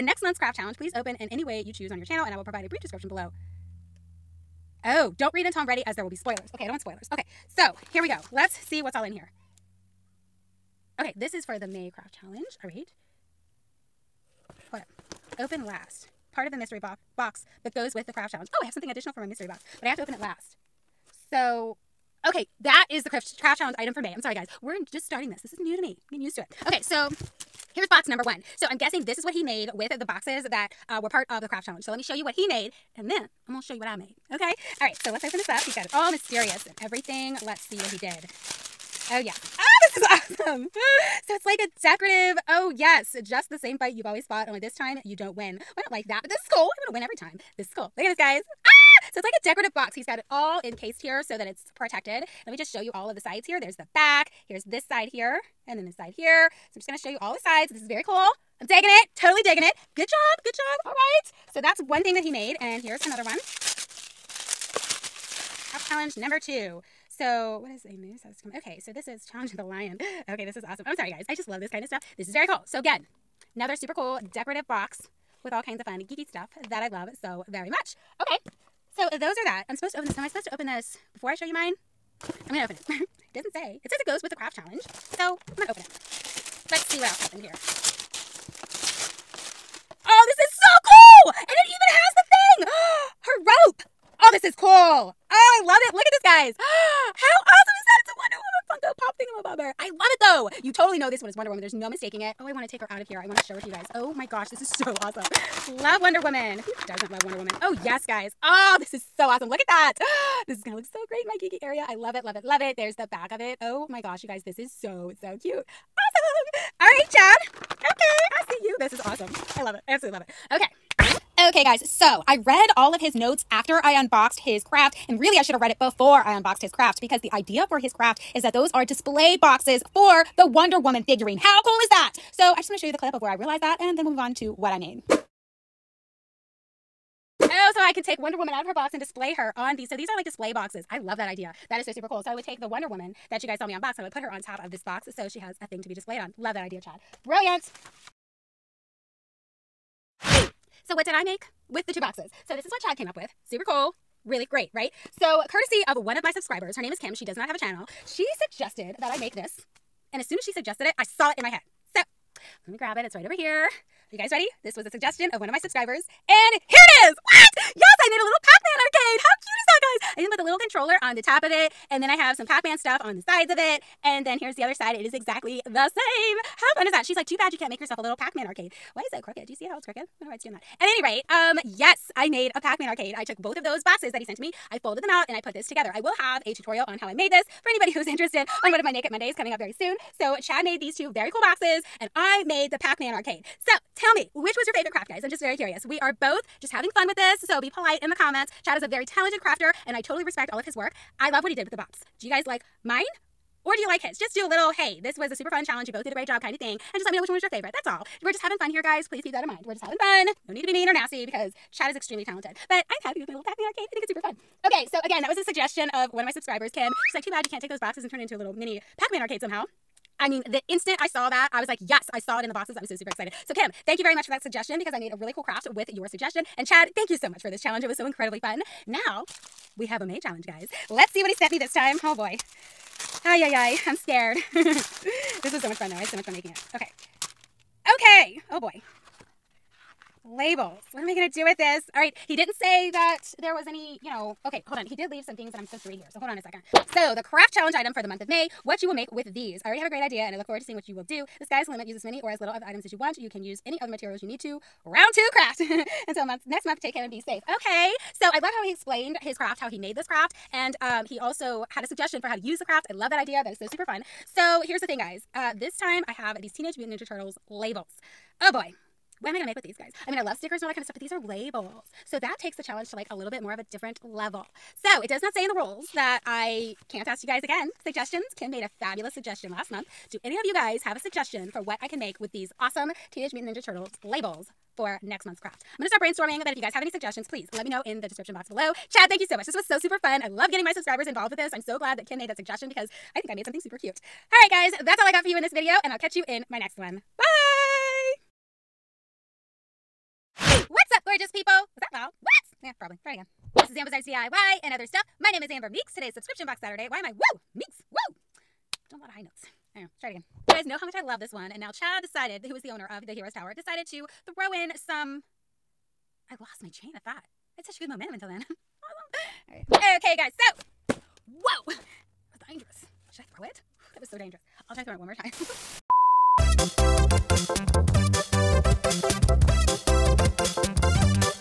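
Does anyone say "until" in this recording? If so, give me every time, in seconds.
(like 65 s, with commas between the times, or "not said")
5 s, 256 s, 318 s.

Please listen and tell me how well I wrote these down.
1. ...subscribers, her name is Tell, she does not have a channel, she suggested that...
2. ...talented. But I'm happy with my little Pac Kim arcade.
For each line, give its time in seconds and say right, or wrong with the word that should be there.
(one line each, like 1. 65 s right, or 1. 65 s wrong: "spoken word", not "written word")
1. 156 s wrong: "Kim", not "Tell"
2. 212 s wrong: "Man", not "Kim".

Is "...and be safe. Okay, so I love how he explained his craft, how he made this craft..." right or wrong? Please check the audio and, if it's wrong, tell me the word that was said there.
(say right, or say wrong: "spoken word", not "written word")
right.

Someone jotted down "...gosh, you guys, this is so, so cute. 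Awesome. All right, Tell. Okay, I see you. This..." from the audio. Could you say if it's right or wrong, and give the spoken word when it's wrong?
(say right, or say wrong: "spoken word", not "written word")
wrong: "Chad", not "Tell".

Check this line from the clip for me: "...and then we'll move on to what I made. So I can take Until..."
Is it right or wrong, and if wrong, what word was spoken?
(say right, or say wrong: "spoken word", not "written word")
wrong: "Wonder", not "Until".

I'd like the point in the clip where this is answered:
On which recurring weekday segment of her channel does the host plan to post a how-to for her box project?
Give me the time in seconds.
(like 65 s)
188 s.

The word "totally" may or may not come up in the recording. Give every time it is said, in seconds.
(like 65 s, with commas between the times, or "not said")
59 s, 200 s.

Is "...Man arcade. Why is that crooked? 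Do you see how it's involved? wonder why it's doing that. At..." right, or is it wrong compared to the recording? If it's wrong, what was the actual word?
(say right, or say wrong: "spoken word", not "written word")
wrong: "crooked", not "involved".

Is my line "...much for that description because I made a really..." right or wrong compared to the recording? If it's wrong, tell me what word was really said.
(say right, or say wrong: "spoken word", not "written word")
wrong: "suggestion", not "description".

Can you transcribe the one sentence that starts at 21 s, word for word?
So, okay, that is the craft, challenge item for May.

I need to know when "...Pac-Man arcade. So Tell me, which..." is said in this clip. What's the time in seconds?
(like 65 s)
192 s.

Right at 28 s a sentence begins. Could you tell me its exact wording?
So I'm guessing this is what he made with the boxes that uh, were part of the craft challenge.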